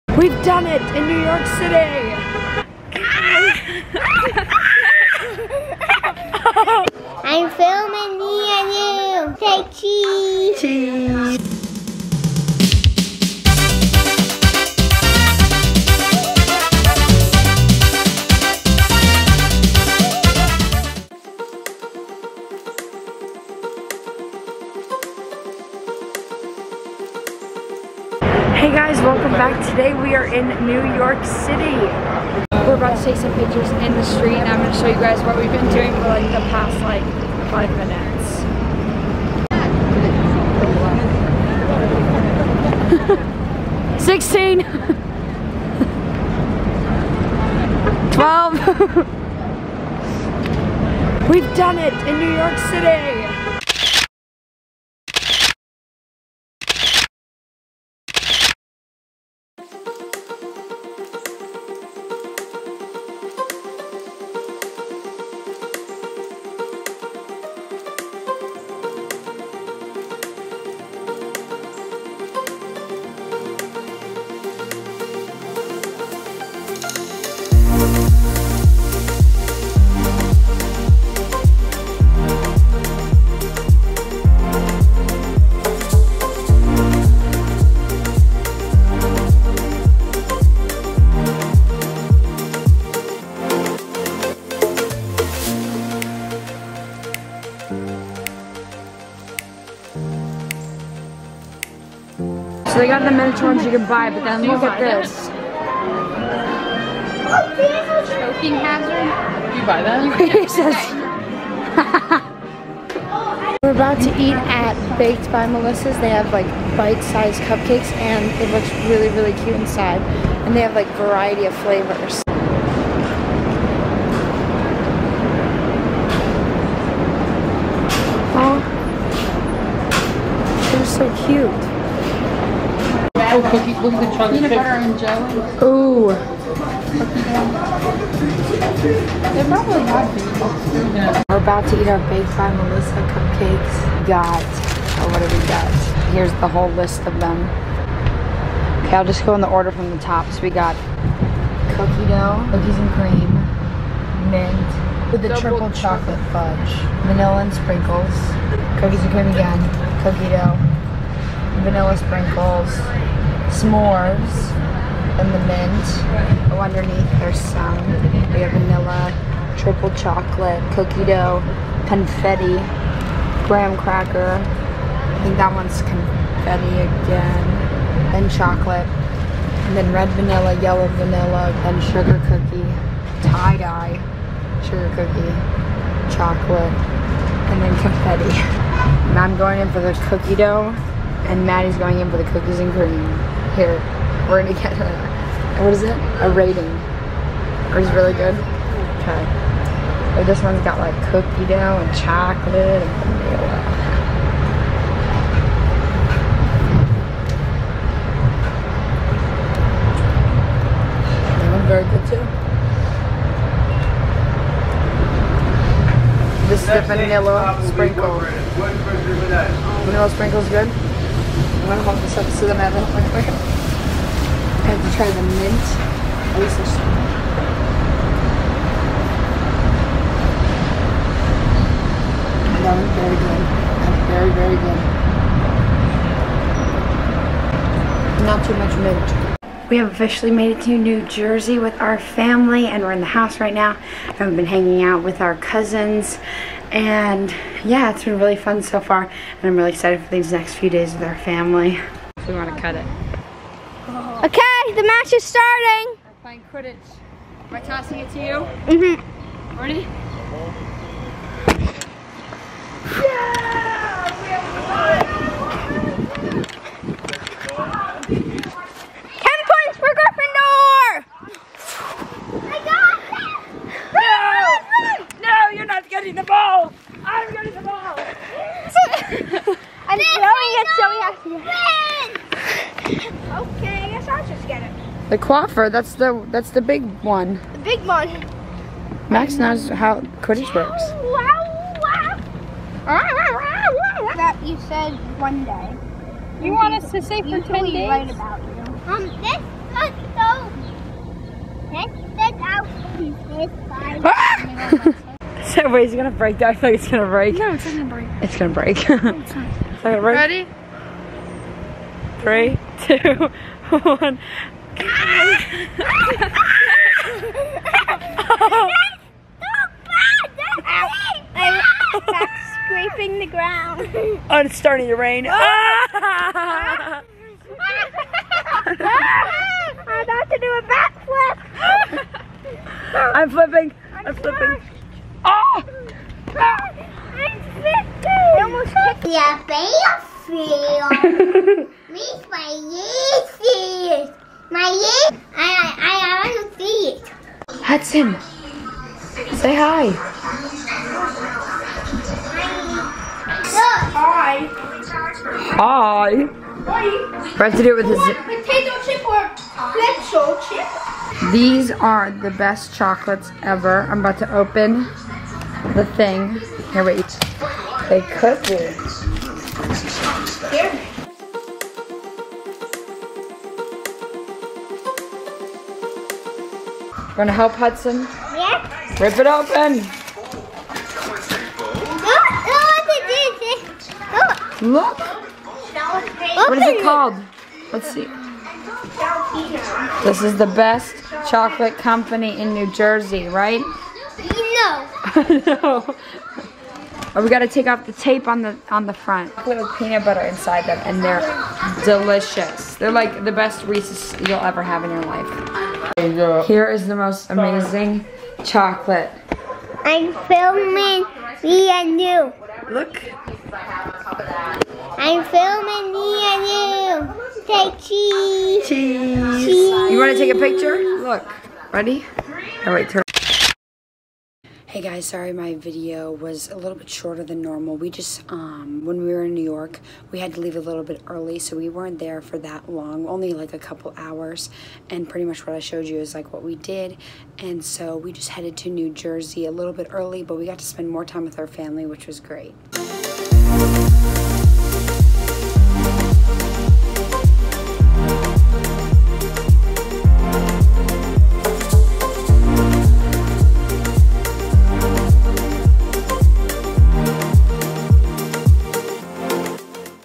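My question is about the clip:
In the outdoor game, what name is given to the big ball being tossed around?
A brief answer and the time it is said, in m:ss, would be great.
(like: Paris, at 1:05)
Quaffle, at 4:45.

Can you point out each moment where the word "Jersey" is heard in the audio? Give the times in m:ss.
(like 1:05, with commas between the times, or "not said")
4:01, 6:32, 7:18.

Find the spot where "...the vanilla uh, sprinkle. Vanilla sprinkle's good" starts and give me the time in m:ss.
3:36.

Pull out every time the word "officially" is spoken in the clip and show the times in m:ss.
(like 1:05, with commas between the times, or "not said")
3:59.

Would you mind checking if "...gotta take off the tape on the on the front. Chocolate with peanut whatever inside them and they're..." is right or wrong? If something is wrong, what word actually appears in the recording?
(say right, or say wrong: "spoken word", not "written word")
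wrong: "butter", not "whatever".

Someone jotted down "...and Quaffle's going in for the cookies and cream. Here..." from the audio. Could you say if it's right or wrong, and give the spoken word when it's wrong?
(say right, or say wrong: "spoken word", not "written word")
wrong: "Maddie", not "Quaffle".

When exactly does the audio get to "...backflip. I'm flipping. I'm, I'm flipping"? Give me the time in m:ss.
5:30.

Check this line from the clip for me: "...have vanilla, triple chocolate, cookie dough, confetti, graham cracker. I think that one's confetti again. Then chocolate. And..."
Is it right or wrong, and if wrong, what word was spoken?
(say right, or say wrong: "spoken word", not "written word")
right.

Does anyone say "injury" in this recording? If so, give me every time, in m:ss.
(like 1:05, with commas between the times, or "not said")
not said.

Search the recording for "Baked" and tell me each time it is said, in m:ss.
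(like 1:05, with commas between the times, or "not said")
1:54, 2:22.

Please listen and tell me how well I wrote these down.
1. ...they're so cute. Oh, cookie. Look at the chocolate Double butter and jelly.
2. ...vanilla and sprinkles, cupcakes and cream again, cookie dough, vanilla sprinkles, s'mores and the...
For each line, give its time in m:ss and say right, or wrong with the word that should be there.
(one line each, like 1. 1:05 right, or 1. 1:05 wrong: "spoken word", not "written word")
1. 2:10 wrong: "Peanut", not "Double"
2. 2:37 wrong: "cookies", not "cupcakes".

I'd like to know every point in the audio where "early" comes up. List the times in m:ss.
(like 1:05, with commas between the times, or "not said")
7:11, 7:19.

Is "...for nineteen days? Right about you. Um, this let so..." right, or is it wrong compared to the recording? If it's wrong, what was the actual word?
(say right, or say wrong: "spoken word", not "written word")
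wrong: "ten", not "nineteen".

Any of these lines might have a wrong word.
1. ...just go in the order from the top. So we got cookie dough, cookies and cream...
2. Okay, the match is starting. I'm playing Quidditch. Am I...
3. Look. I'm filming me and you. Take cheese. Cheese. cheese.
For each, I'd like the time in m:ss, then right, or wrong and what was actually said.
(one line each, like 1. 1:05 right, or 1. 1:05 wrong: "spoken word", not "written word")
1. 2:29 right
2. 4:14 right
3. 6:52 right.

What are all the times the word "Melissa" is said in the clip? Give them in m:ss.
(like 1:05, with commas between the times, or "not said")
1:55, 2:22.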